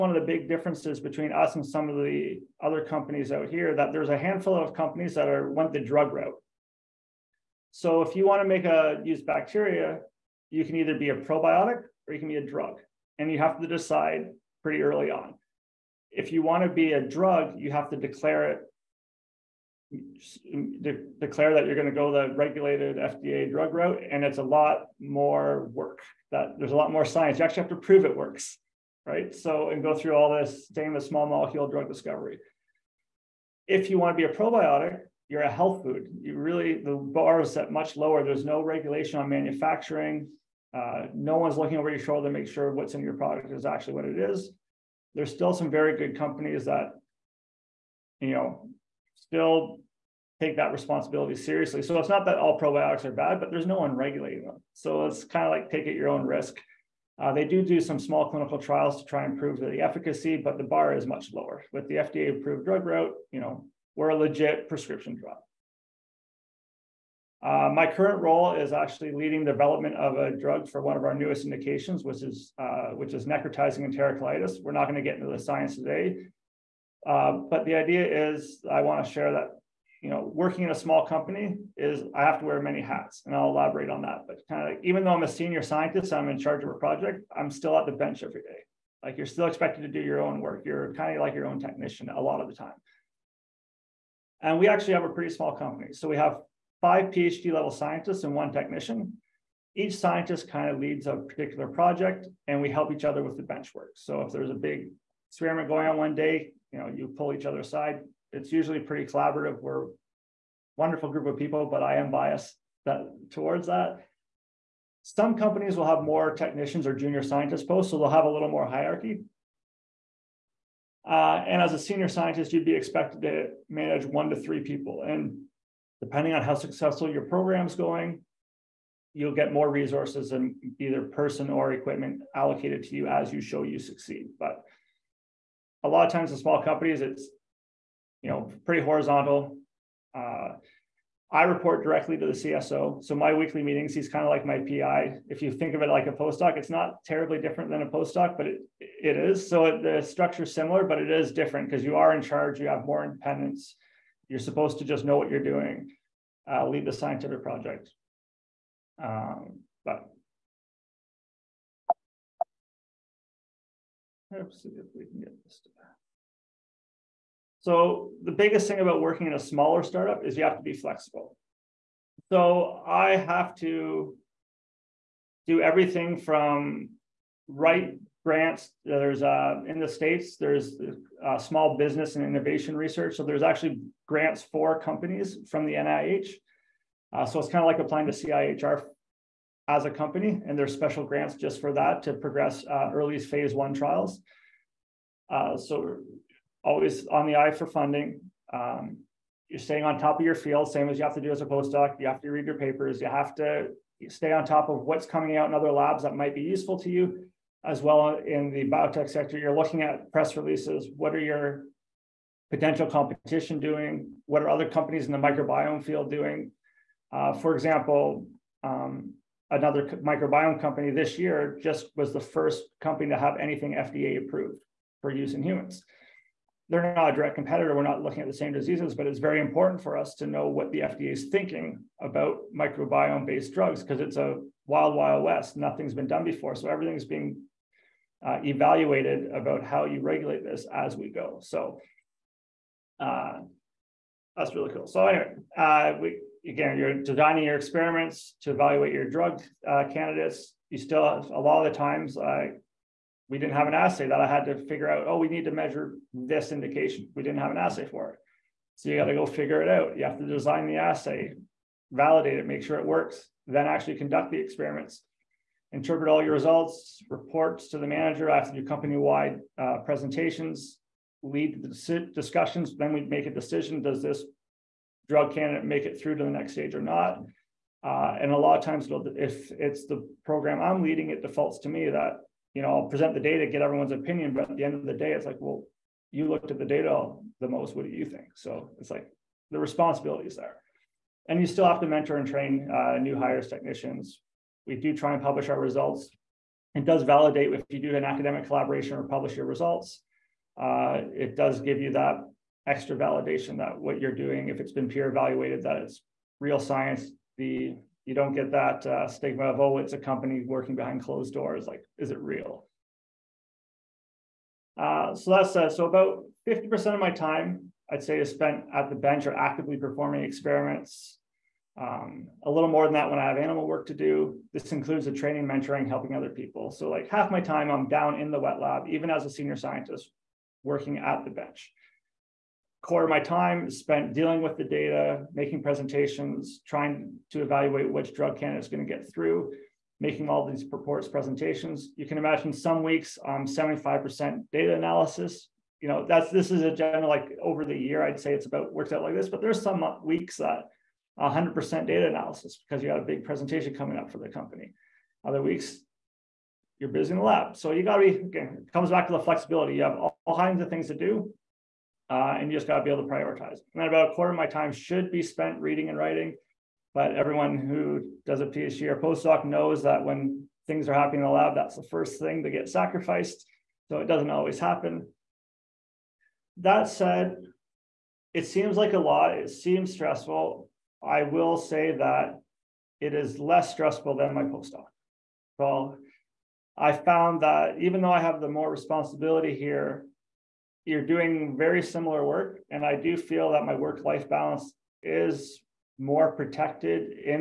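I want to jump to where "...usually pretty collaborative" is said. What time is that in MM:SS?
01:48.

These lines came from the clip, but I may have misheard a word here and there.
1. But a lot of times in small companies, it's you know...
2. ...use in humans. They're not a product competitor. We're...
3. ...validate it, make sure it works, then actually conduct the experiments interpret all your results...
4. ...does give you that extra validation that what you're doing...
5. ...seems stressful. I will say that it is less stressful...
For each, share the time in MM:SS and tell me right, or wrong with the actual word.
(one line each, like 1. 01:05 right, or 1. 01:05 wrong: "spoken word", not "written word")
1. 02:14 right
2. 03:45 wrong: "direct", not "product"
3. 04:21 right
4. 05:01 right
5. 06:19 right.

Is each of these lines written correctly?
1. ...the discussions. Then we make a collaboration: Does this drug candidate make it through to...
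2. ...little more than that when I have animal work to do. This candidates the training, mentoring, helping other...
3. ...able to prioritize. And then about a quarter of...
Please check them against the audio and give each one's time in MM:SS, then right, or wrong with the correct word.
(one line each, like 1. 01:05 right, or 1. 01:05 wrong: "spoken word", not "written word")
1. 04:31 wrong: "decision", not "collaboration"
2. 05:22 wrong: "includes", not "candidates"
3. 06:02 right.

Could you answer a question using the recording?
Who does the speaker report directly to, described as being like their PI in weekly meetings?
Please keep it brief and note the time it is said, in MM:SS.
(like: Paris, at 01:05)
CSO, at 02:22.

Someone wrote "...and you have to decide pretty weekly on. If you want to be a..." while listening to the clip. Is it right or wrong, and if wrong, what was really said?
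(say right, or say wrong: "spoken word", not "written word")
wrong: "early", not "weekly".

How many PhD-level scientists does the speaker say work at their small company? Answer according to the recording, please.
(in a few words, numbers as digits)
5.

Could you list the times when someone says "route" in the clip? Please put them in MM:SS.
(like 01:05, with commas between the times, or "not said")
00:06, 00:23, 01:02.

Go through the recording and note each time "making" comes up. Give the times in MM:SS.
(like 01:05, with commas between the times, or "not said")
05:35, 05:40.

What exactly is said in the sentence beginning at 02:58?
There's uh, in the states there's uh, small business and innovation research.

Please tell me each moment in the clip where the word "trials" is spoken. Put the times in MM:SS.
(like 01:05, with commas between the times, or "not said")
00:58, 03:13.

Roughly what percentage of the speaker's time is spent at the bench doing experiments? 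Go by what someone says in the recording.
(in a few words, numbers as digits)
50%.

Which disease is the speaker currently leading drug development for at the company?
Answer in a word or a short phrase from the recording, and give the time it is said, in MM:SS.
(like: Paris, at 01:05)
Necrotizing enterocolitis, at 01:13.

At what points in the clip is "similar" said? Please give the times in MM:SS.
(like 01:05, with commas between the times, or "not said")
02:30, 06:31.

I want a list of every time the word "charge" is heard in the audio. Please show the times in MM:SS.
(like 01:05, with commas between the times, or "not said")
01:26, 02:32.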